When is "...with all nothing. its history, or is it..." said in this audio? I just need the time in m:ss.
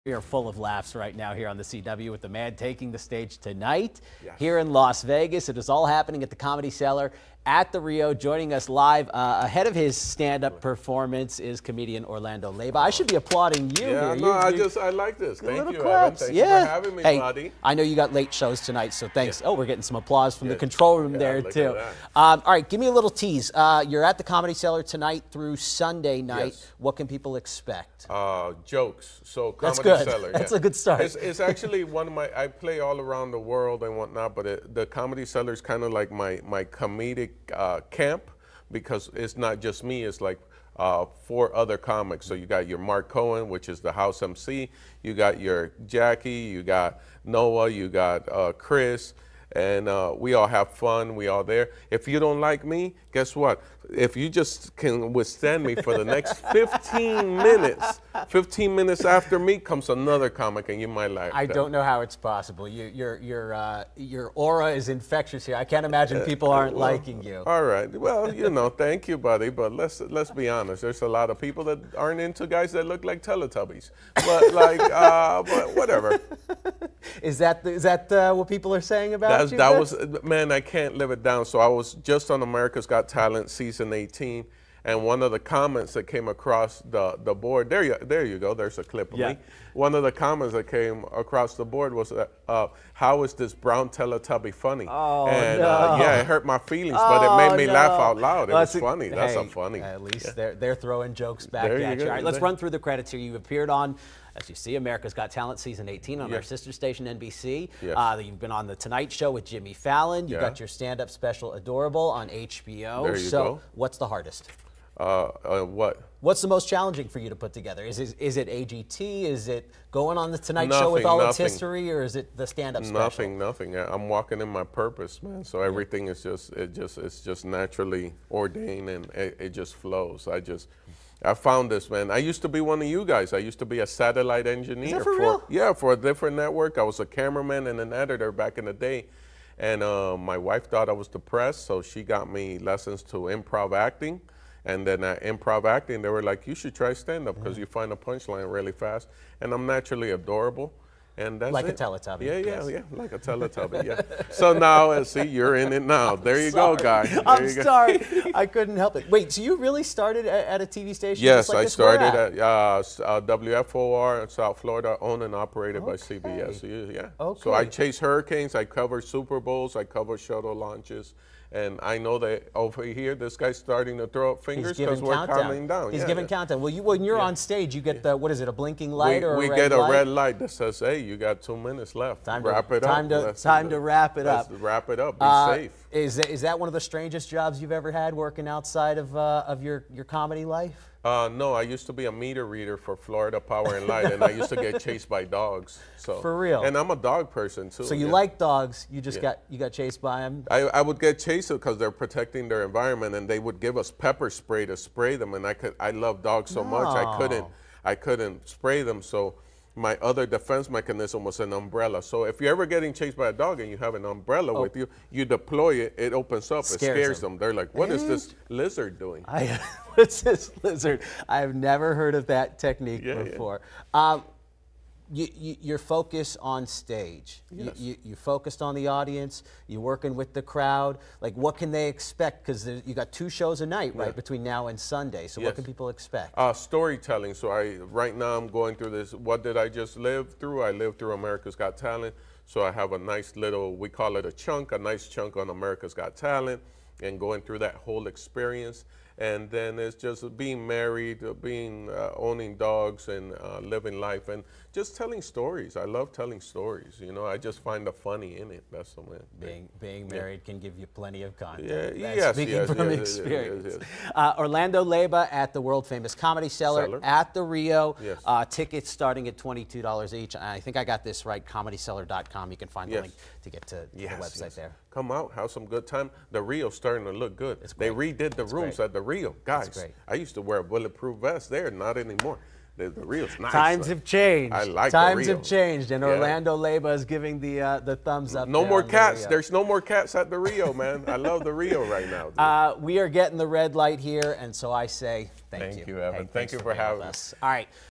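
2:00.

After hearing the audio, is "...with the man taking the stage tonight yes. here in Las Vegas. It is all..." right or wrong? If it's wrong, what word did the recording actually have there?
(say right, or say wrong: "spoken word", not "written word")
right.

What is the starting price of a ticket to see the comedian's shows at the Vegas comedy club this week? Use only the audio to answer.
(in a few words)
$22.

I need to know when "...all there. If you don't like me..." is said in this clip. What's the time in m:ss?
0:51.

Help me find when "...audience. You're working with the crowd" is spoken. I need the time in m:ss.
3:48.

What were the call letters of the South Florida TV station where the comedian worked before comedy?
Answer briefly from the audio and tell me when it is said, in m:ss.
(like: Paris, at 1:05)
WFOR, at 2:43.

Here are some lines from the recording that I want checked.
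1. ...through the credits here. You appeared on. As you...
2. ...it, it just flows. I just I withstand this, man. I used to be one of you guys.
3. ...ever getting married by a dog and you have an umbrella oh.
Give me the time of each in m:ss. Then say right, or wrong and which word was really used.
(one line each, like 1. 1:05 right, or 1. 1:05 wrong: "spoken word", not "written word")
1. 1:42 right
2. 2:09 wrong: "found", not "withstand"
3. 3:32 wrong: "chased", not "married".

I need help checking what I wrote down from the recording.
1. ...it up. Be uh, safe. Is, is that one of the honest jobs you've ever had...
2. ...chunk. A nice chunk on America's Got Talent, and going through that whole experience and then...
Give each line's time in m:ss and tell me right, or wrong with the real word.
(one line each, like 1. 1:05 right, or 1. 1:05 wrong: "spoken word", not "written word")
1. 3:04 wrong: "strangest", not "honest"
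2. 4:04 right.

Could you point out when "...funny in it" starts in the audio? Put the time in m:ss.
4:17.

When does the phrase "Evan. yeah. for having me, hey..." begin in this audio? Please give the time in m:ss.
0:16.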